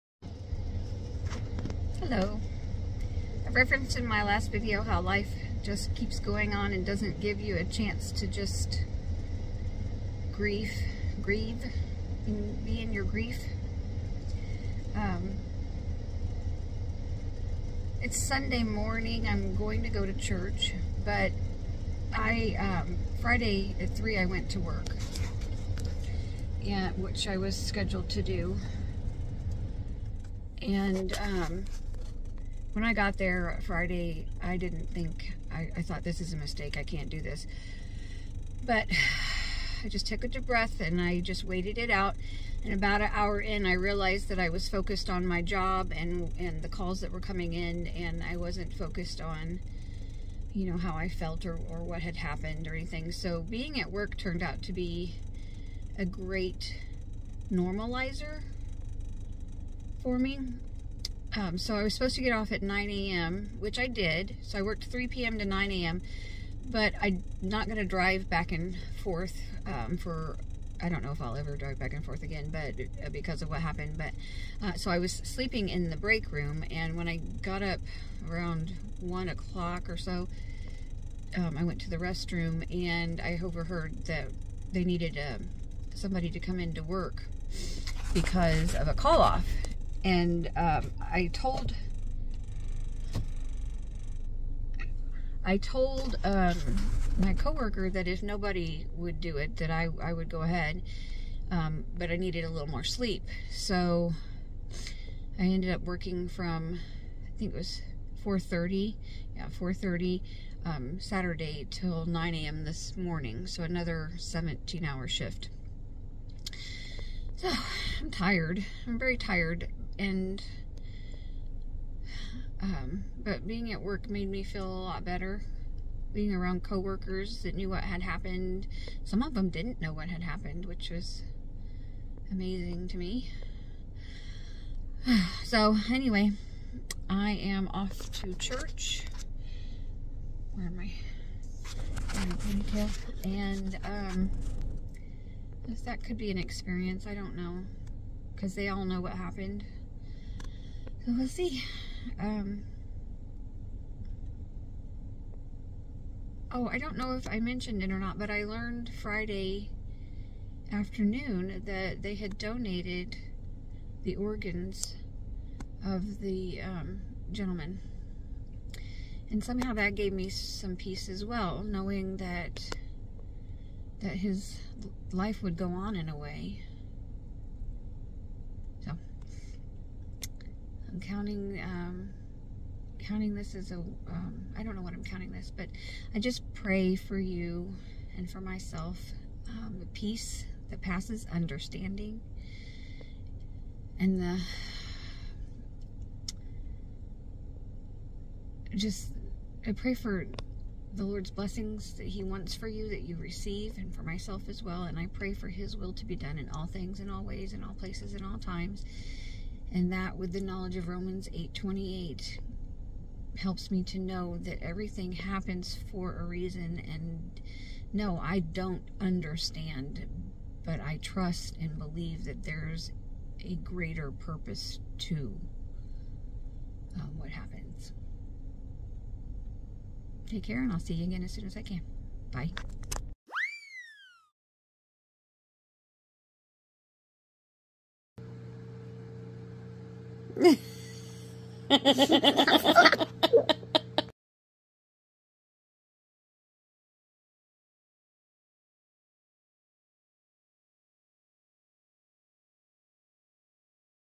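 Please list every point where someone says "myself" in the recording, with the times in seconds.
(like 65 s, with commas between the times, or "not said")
188 s, 204 s.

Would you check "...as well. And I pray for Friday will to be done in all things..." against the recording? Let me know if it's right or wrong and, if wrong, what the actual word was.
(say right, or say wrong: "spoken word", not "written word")
wrong: "His", not "Friday".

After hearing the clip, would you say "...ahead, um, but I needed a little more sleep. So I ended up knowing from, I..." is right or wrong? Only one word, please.
wrong.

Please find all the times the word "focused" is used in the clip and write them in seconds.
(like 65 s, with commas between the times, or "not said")
44 s, 48 s.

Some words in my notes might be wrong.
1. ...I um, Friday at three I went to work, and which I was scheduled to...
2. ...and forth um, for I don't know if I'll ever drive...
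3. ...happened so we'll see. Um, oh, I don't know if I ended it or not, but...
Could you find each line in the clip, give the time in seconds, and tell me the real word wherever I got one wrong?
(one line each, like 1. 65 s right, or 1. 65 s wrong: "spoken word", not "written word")
1. 22 s right
2. 68 s right
3. 149 s wrong: "mentioned", not "ended".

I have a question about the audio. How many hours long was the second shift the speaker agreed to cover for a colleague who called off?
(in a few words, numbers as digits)
17.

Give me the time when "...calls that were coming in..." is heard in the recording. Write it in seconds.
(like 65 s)
46 s.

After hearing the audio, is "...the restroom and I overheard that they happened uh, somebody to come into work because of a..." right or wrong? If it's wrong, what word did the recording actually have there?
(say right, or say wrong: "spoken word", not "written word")
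wrong: "needed", not "happened".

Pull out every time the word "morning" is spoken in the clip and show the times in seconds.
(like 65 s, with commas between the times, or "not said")
18 s, 112 s.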